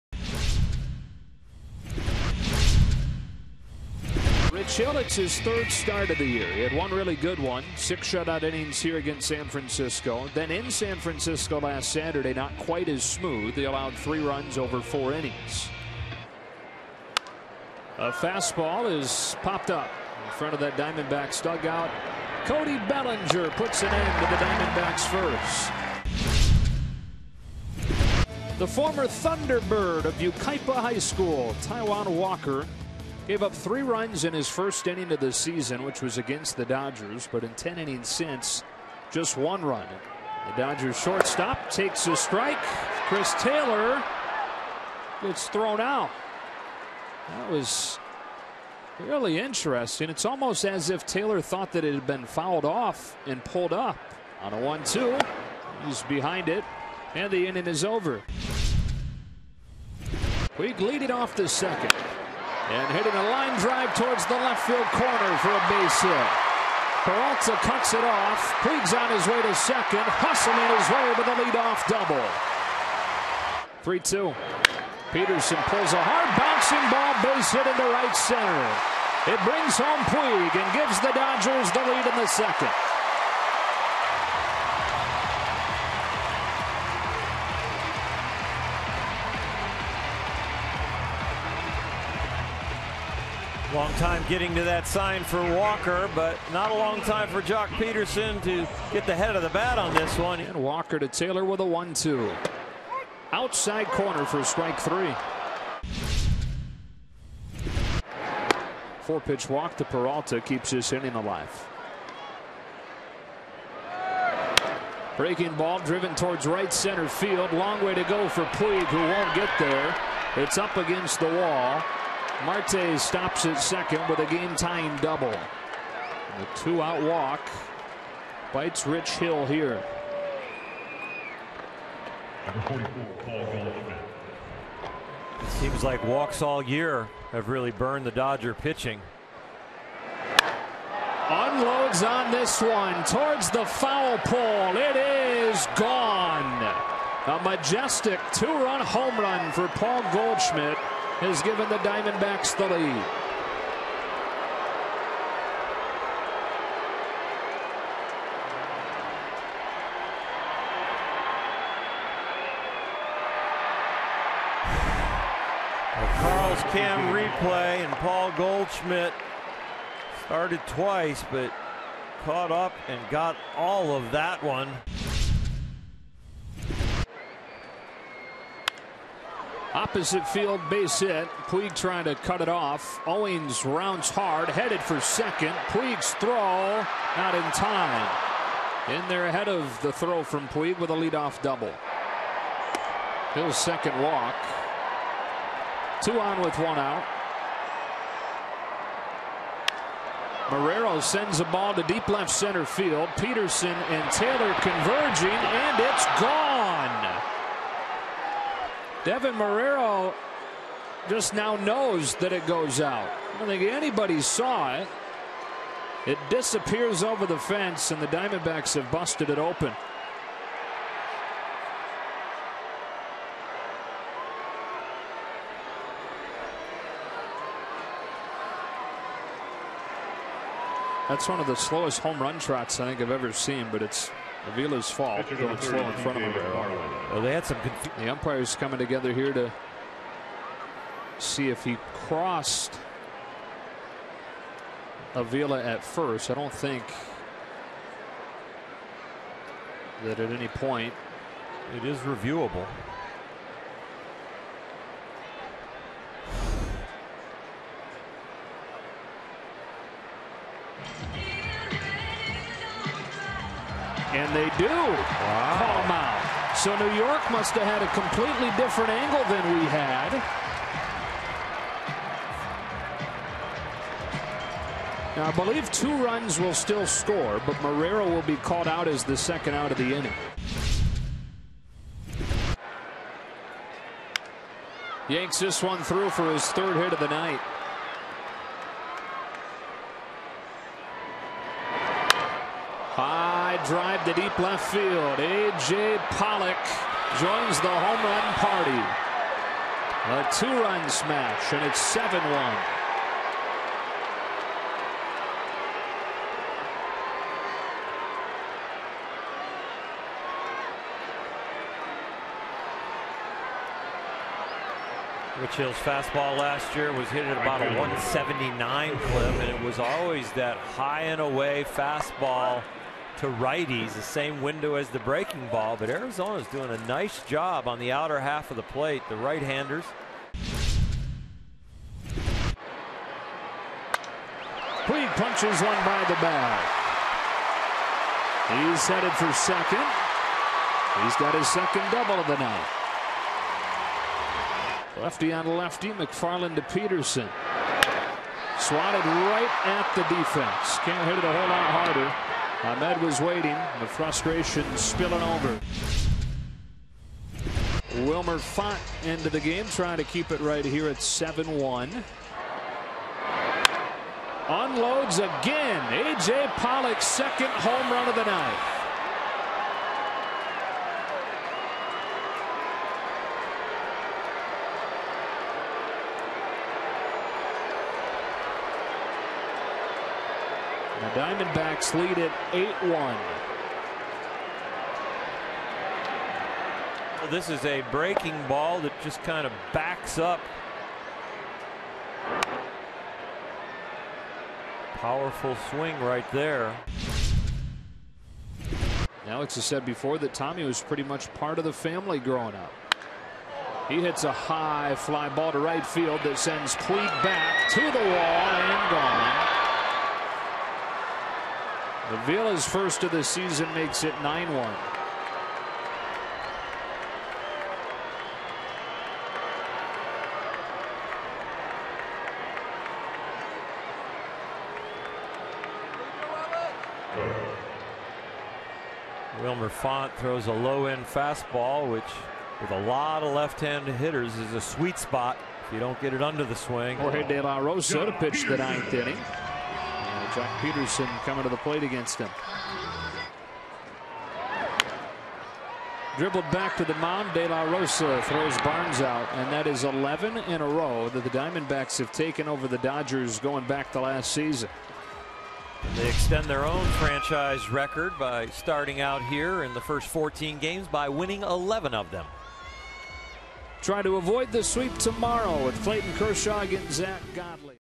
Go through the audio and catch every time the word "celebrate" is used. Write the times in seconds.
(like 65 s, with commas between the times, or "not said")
not said.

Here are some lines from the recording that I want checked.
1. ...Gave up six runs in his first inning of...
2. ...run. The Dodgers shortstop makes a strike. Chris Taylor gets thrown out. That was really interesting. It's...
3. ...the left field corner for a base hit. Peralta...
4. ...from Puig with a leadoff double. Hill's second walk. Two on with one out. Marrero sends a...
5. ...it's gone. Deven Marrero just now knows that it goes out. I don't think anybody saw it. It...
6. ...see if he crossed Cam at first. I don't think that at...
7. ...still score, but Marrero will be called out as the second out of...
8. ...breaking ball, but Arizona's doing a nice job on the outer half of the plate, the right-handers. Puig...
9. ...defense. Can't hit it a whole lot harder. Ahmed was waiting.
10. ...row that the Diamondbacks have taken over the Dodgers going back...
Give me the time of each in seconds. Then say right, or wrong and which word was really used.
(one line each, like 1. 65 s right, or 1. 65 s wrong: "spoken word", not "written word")
1. 33 s wrong: "three", not "six"
2. 39 s wrong: "takes", not "makes"
3. 64 s right
4. 190 s right
5. 205 s right
6. 241 s wrong: "Avila", not "Cam"
7. 276 s right
8. 324 s right
9. 350 s right
10. 450 s right.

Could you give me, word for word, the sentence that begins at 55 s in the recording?
He's behind it, and the inning is over.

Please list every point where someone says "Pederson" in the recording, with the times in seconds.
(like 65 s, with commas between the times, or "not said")
75 s, 97 s, 203 s, 346 s, 440 s.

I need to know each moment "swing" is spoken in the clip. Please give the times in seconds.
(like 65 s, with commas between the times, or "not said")
395 s, 436 s.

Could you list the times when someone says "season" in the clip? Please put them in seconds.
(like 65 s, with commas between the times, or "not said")
35 s, 413 s, 454 s.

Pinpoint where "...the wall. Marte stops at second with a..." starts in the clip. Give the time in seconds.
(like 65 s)
121 s.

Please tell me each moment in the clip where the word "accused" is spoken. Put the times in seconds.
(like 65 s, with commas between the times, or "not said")
not said.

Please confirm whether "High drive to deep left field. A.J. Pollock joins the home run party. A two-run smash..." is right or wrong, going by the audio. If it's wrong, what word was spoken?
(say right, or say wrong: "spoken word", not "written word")
right.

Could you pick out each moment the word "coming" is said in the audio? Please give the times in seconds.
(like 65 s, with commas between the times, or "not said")
238 s, 441 s.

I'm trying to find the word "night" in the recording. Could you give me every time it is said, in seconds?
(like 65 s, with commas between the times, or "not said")
287 s, 342 s, 368 s.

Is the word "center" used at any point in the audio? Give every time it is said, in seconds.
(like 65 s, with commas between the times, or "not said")
78 s, 116 s, 202 s.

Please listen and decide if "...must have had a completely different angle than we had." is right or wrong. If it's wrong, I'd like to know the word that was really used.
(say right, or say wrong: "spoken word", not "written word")
right.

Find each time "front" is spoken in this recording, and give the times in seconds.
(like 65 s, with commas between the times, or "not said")
20 s, 235 s.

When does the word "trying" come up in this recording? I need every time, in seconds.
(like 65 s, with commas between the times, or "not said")
181 s, 359 s.